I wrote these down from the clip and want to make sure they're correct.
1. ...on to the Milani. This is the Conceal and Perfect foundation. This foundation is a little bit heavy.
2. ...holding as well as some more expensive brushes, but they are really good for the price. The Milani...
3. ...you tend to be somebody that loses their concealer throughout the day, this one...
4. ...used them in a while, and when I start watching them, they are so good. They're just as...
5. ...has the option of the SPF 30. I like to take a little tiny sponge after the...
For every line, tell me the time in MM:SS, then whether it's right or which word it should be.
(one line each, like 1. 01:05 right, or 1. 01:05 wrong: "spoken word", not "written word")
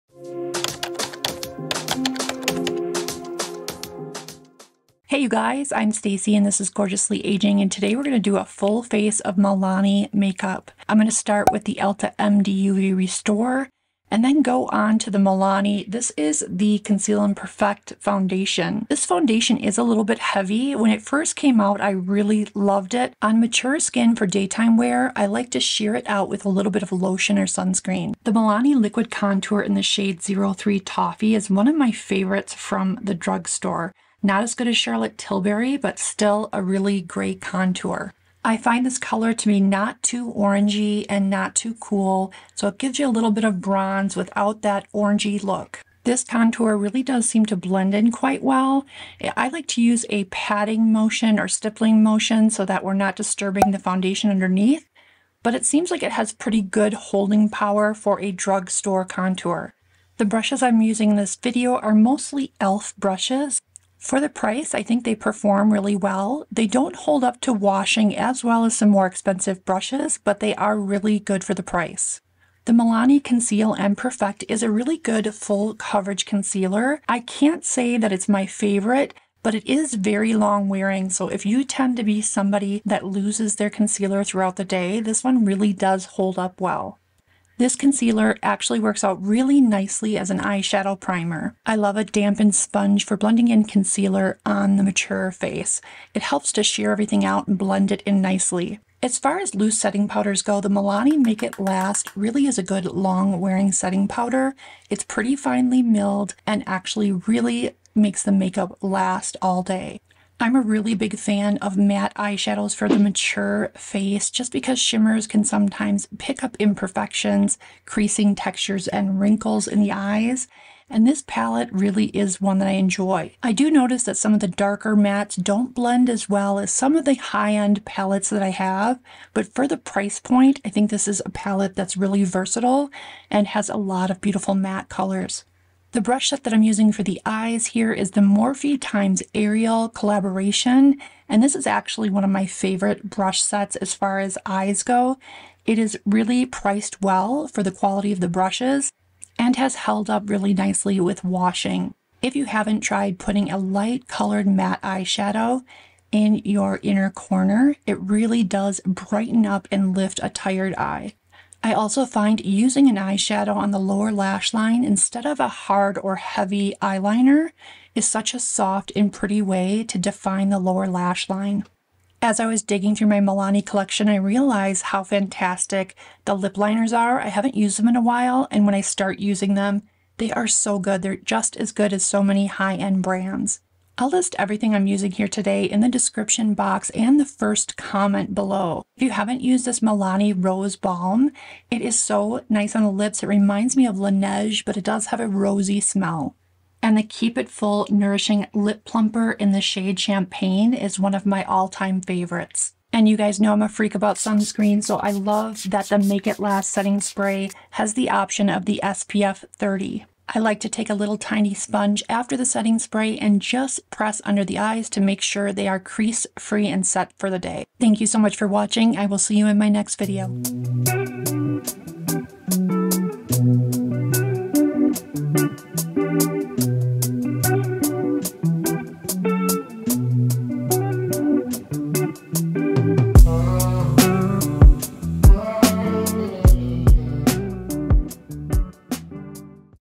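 1. 00:14 right
2. 01:07 wrong: "washing", not "holding"
3. 01:21 right
4. 02:57 wrong: "using", not "watching"
5. 03:27 right.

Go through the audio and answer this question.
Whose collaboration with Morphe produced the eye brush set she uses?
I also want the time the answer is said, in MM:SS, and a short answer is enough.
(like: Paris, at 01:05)
Ariel, at 02:19.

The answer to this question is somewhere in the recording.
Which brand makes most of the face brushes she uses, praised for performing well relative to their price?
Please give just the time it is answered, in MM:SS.
01:02.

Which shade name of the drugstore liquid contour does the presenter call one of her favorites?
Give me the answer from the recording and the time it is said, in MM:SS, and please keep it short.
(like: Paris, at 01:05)
Toffee, at 00:30.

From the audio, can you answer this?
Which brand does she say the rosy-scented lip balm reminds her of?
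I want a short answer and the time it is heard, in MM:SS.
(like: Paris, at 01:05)
Laneige, at 03:13.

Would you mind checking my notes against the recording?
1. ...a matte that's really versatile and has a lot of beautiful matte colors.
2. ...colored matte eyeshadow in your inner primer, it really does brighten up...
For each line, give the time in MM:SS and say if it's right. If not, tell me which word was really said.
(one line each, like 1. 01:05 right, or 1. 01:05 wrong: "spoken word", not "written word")
1. 02:11 wrong: "palette", not "matte"
2. 02:34 wrong: "corner", not "primer".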